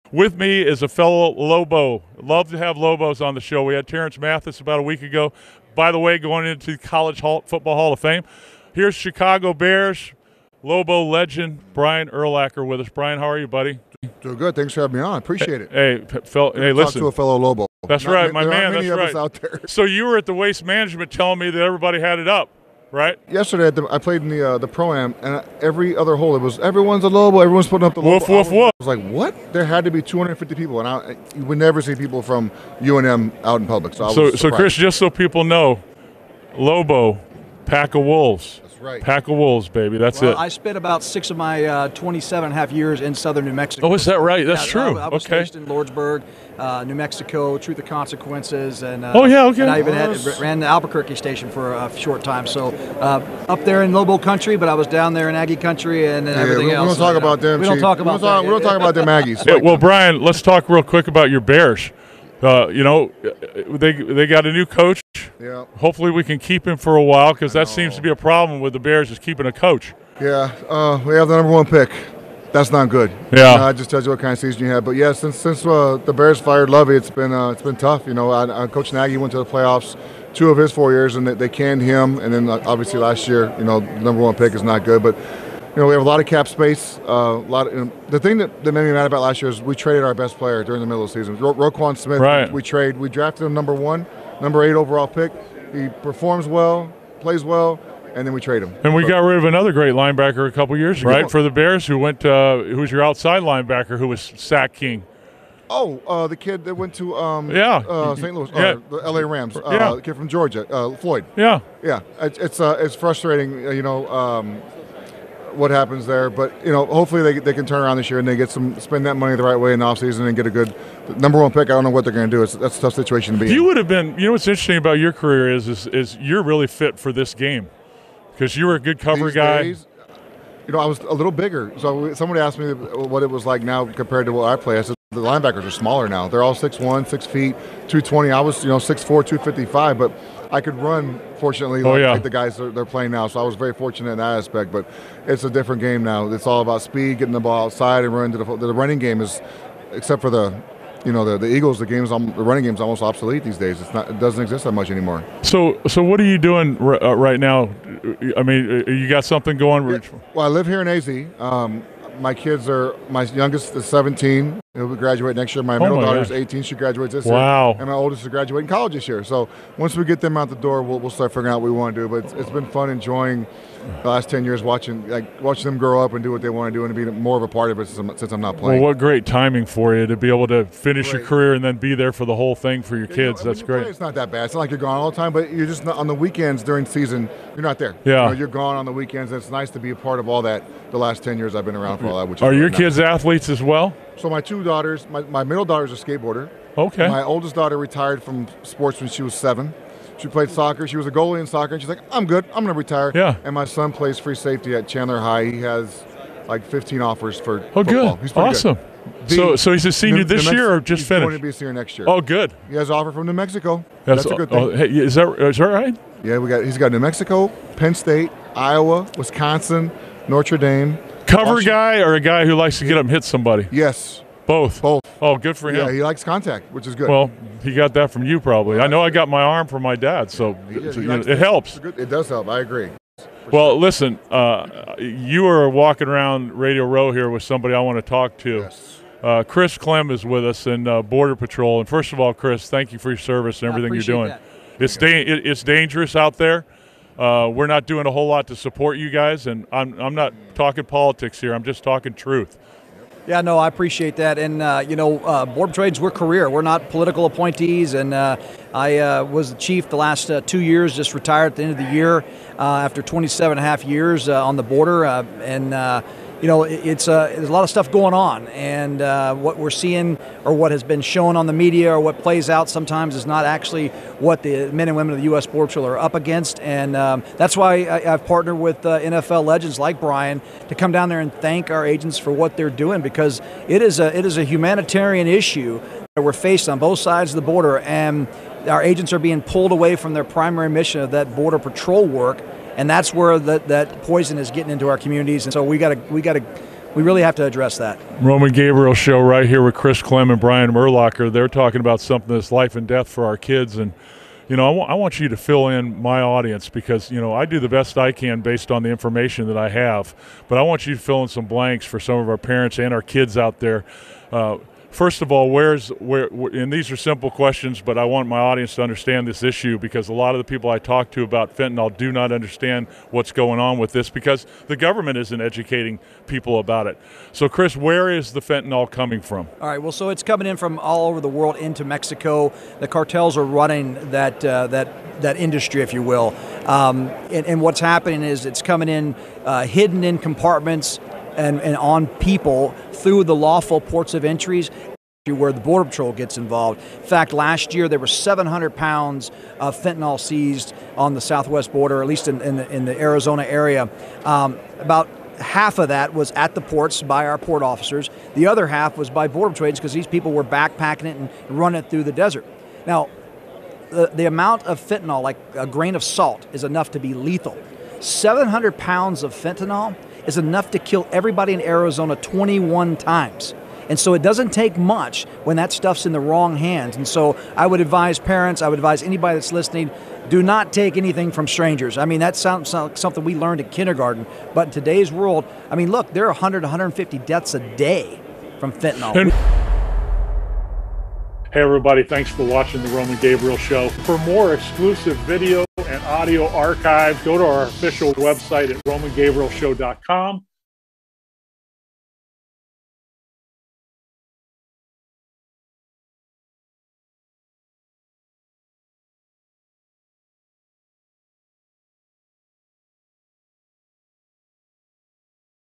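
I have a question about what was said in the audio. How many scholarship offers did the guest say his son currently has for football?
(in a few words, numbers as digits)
15.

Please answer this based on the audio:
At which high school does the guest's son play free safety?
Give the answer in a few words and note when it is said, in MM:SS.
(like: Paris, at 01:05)
Chandler High, at 03:24.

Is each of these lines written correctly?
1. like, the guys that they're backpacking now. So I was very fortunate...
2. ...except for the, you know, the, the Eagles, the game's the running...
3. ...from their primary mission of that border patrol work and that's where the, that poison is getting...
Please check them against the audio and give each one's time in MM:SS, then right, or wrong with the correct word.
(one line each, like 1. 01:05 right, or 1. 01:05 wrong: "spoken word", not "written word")
1. 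02:22 wrong: "playing", not "backpacking"
2. 02:29 right
3. 04:49 right.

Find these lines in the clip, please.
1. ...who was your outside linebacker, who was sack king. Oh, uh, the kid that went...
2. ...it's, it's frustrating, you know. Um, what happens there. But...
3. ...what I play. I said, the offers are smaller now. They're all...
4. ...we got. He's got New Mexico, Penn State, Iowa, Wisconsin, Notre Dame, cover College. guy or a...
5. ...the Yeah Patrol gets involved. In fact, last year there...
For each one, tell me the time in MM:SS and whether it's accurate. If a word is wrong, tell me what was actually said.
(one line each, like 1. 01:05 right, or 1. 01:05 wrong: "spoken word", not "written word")
1. 01:42 right
2. 01:52 right
3. 02:14 wrong: "linebackers", not "offers"
4. 03:36 wrong: "Washington", not "College"
5. 05:45 wrong: "Border", not "Yeah".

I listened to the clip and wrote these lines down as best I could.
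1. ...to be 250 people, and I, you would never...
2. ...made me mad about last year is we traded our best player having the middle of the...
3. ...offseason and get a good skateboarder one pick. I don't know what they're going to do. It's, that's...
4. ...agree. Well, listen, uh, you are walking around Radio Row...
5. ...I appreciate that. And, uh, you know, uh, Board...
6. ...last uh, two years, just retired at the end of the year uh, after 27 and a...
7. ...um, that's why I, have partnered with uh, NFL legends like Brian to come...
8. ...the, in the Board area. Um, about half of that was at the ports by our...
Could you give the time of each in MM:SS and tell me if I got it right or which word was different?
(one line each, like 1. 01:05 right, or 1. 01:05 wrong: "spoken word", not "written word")
1. 00:29 right
2. 01:28 wrong: "during", not "having"
3. 01:59 wrong: "number", not "skateboarder"
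4. 03:52 right
5. 04:13 right
6. 04:19 right
7. 04:36 right
8. 05:52 wrong: "Arizona", not "Board".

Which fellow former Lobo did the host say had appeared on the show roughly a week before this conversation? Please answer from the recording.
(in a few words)
Terrence Mathis.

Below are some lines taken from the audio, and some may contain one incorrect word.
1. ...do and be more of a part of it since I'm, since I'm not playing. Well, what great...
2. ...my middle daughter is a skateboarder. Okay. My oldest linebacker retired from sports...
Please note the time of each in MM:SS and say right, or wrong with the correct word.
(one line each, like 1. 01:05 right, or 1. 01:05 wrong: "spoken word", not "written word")
1. 02:56 right
2. 03:15 wrong: "daughter", not "linebacker".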